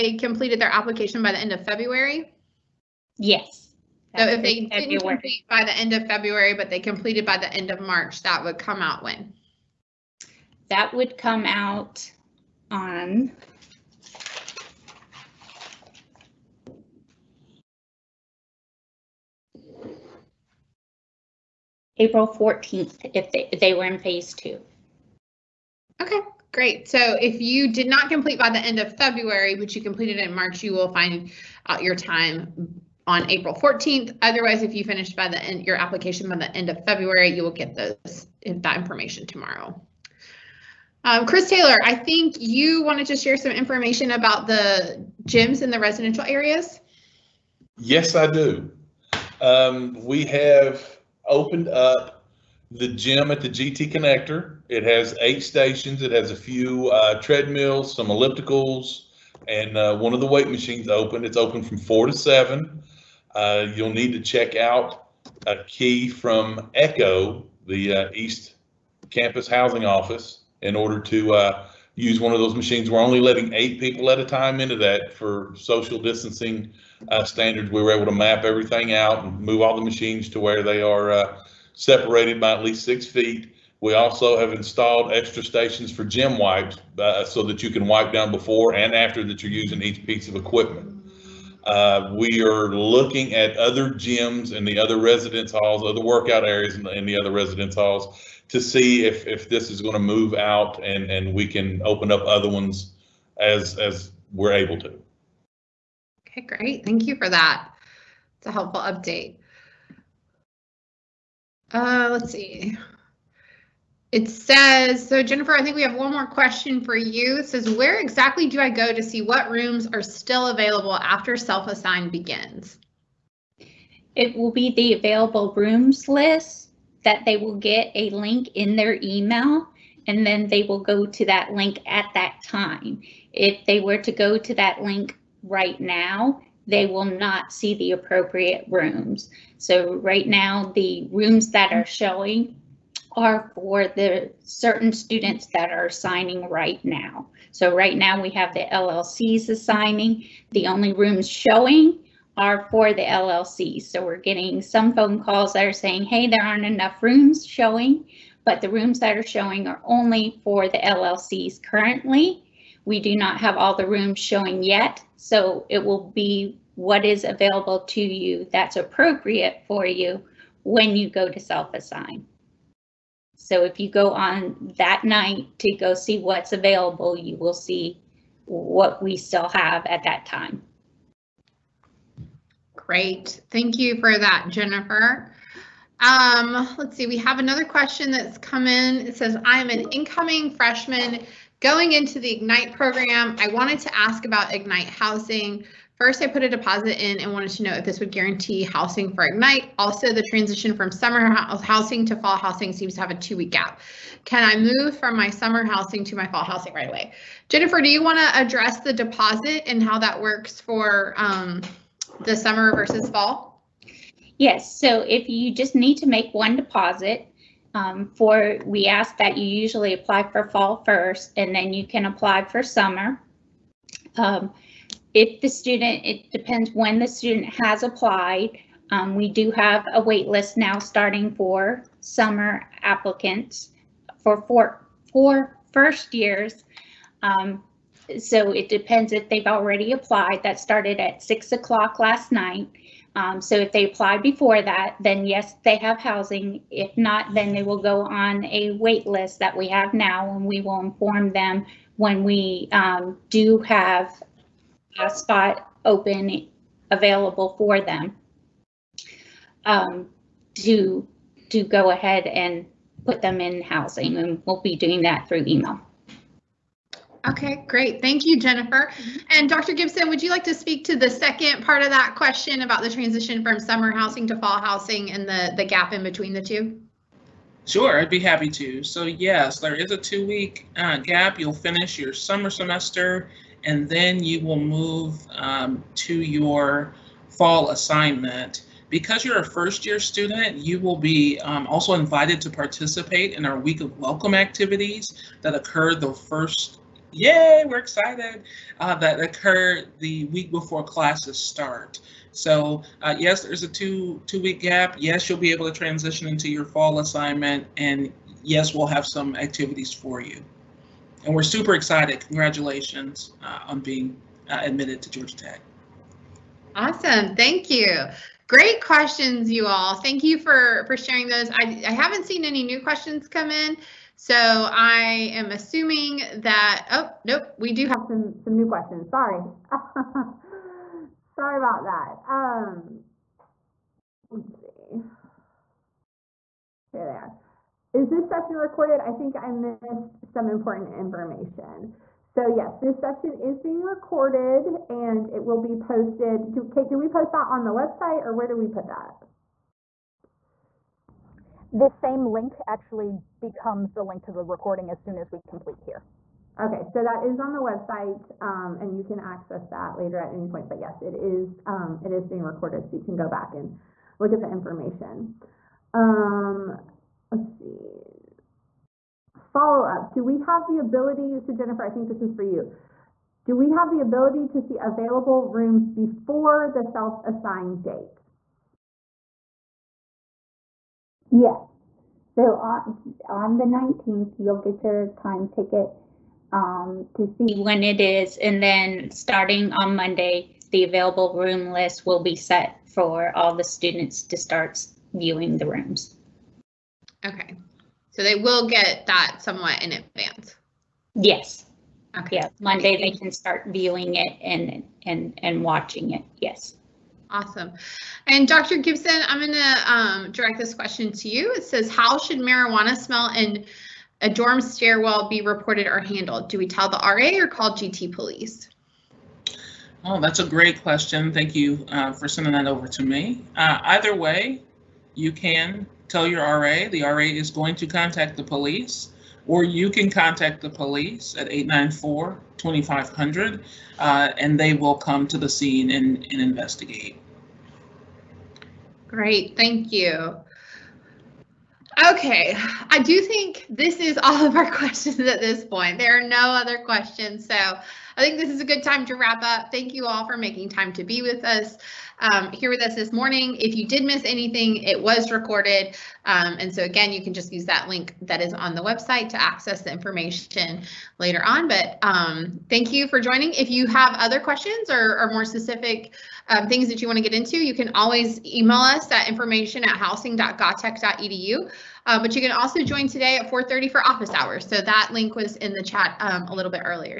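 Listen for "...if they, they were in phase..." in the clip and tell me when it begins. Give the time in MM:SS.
00:23.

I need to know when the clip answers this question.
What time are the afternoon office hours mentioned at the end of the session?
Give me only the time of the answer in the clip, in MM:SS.
07:53.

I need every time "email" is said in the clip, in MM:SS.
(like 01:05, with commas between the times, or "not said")
02:09, 04:25, 07:48.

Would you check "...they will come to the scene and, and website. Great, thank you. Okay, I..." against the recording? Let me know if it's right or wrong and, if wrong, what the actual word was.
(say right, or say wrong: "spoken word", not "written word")
wrong: "investigate", not "website".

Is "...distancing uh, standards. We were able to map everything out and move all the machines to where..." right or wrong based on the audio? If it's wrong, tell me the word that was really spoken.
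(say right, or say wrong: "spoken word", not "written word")
right.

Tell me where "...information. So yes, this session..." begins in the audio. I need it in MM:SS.
05:40.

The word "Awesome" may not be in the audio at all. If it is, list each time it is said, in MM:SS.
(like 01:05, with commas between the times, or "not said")
05:16, 06:47.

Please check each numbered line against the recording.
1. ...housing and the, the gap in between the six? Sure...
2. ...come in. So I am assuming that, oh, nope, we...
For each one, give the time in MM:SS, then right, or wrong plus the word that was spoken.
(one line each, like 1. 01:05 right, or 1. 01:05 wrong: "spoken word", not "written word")
1. 04:34 wrong: "two", not "six"
2. 05:23 right.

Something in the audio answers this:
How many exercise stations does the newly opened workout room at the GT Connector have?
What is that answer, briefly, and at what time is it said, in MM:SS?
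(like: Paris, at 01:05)
8, at 00:55.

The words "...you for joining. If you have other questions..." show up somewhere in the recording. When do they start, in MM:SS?
07:42.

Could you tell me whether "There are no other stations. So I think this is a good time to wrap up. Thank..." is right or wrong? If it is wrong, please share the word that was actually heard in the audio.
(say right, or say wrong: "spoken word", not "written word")
wrong: "questions", not "stations".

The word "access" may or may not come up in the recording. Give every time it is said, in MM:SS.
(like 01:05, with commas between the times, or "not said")
05:59, 07:39.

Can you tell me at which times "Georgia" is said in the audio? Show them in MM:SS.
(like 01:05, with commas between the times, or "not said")
05:15.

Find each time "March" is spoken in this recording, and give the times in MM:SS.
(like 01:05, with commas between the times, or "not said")
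00:07, 00:30.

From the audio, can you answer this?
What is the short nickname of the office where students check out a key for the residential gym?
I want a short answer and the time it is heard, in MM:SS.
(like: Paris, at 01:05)
Echo, at 01:06.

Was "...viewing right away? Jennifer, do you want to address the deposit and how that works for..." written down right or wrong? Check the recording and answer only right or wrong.
wrong.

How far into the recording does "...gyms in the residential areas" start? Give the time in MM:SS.
00:45.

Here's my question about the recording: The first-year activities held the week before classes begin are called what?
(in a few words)
Week of Welcome.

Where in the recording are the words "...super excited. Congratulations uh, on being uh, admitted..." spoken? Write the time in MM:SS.
05:11.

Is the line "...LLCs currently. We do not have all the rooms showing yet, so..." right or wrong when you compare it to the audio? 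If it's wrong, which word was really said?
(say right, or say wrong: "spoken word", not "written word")
right.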